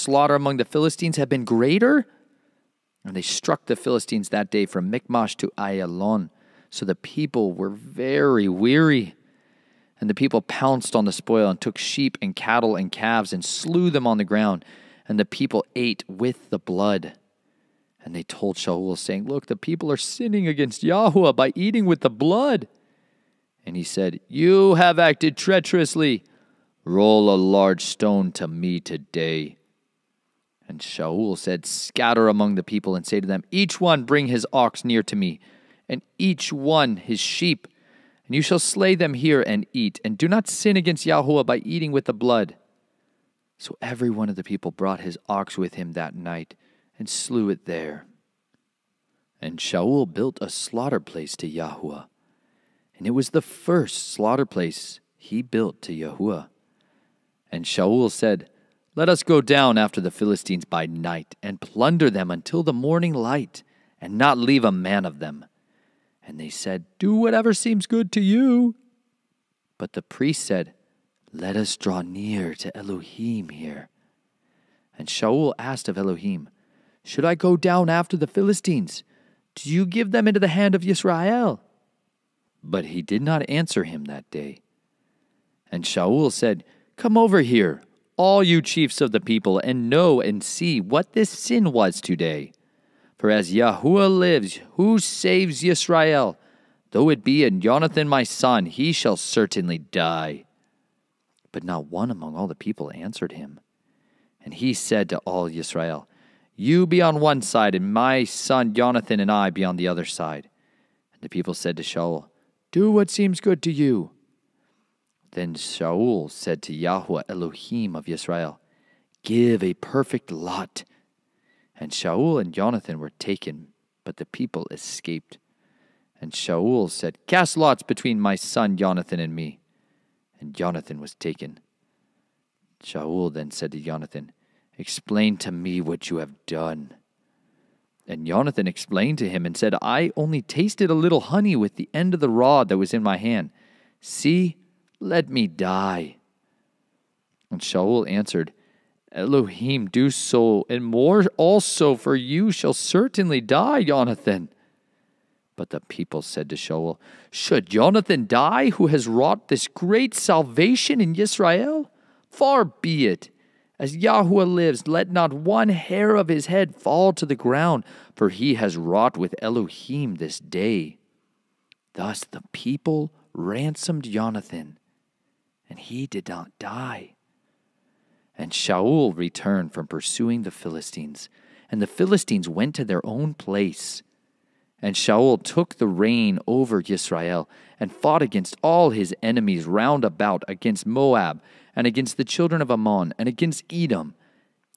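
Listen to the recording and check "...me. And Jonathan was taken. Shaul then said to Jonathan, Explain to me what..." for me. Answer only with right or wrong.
right.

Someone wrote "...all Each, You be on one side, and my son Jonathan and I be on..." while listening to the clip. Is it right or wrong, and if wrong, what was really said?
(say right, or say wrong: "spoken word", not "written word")
wrong: "Yisrael", not "Each".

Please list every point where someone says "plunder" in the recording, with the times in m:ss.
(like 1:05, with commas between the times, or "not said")
1:01.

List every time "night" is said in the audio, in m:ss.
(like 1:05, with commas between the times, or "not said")
0:46, 1:00.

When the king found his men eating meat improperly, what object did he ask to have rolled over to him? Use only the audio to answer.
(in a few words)
A large stone.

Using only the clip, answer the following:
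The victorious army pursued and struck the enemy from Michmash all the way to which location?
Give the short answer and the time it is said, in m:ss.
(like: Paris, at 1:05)
Ayalon, at 0:05.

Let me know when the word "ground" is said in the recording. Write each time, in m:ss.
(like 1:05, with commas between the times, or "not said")
0:14, 2:47.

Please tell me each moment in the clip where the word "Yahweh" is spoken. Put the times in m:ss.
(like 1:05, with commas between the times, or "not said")
0:20, 0:41, 0:51, 0:55, 1:56, 2:43.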